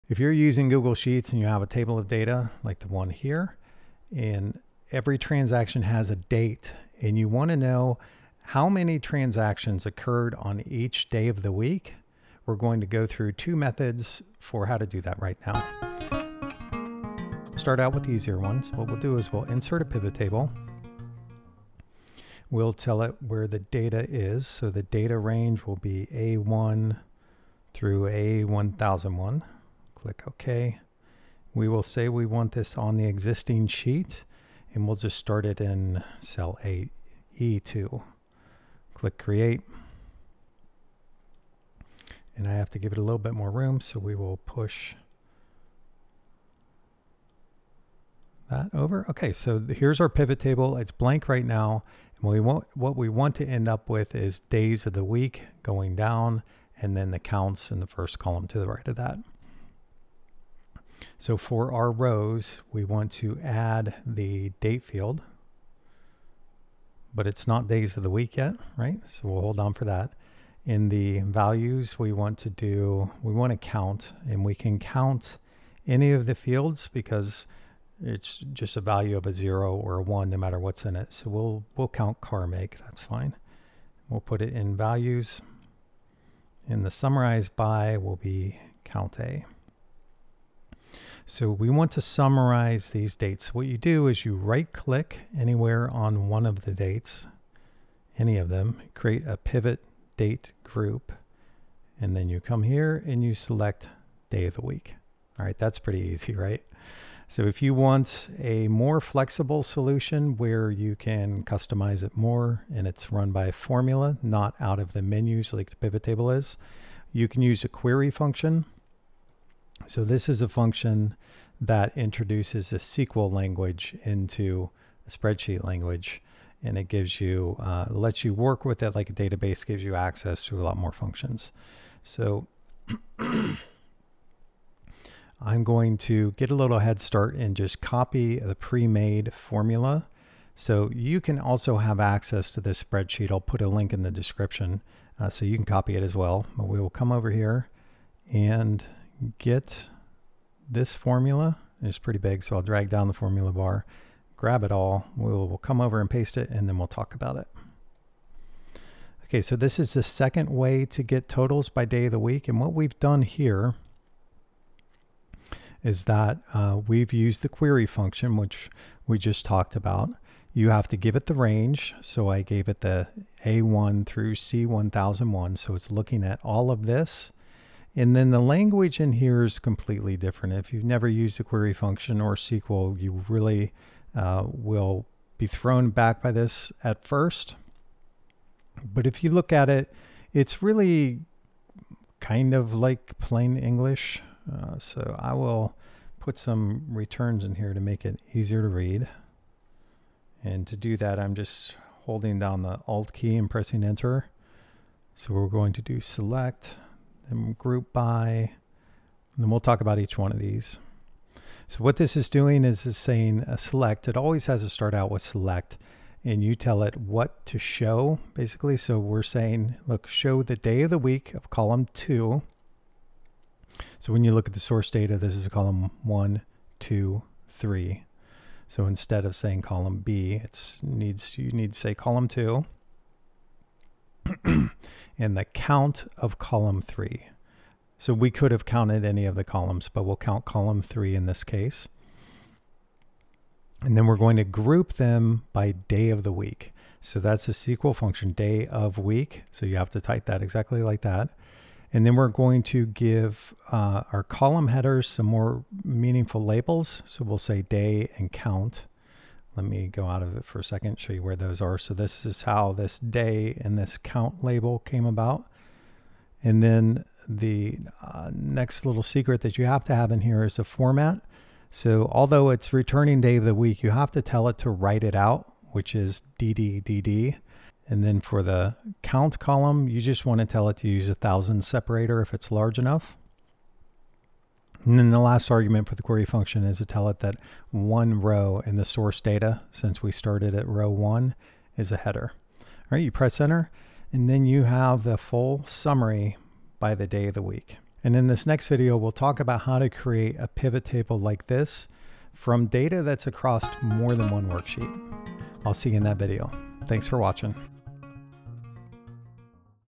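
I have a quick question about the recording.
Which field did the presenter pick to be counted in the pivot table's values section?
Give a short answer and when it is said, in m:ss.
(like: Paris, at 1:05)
car make, at 1:22.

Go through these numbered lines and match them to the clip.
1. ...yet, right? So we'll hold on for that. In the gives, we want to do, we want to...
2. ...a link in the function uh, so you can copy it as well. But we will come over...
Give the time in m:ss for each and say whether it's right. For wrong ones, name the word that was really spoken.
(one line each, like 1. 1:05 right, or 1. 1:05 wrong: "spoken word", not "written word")
1. 1:08 wrong: "values", not "gives"
2. 2:23 wrong: "description", not "function".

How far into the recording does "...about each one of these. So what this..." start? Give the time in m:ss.
3:29.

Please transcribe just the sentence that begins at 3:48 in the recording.
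So instead of saying column B, it needs you need to say column two in the count of column three.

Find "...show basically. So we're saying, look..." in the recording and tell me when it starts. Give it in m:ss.
3:37.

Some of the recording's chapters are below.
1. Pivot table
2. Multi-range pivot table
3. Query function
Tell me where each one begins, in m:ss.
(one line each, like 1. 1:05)
1. 0:21
2. 4:58
3. 1:47.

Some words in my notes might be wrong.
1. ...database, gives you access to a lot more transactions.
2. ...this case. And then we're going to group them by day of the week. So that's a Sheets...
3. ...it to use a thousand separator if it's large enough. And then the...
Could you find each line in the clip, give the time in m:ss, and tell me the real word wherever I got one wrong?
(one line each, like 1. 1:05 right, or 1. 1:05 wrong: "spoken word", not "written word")
1. 2:09 wrong: "functions", not "transactions"
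2. 4:01 wrong: "SQL", not "Sheets"
3. 4:40 right.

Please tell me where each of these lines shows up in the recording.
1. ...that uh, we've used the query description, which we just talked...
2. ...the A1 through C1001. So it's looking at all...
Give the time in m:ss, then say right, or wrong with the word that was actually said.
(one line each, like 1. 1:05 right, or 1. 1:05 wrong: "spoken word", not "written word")
1. 2:46 wrong: "function", not "description"
2. 2:52 right.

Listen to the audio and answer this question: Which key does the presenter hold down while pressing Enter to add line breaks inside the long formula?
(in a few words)
Alt.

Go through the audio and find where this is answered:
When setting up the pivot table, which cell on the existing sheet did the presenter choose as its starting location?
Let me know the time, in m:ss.
0:36.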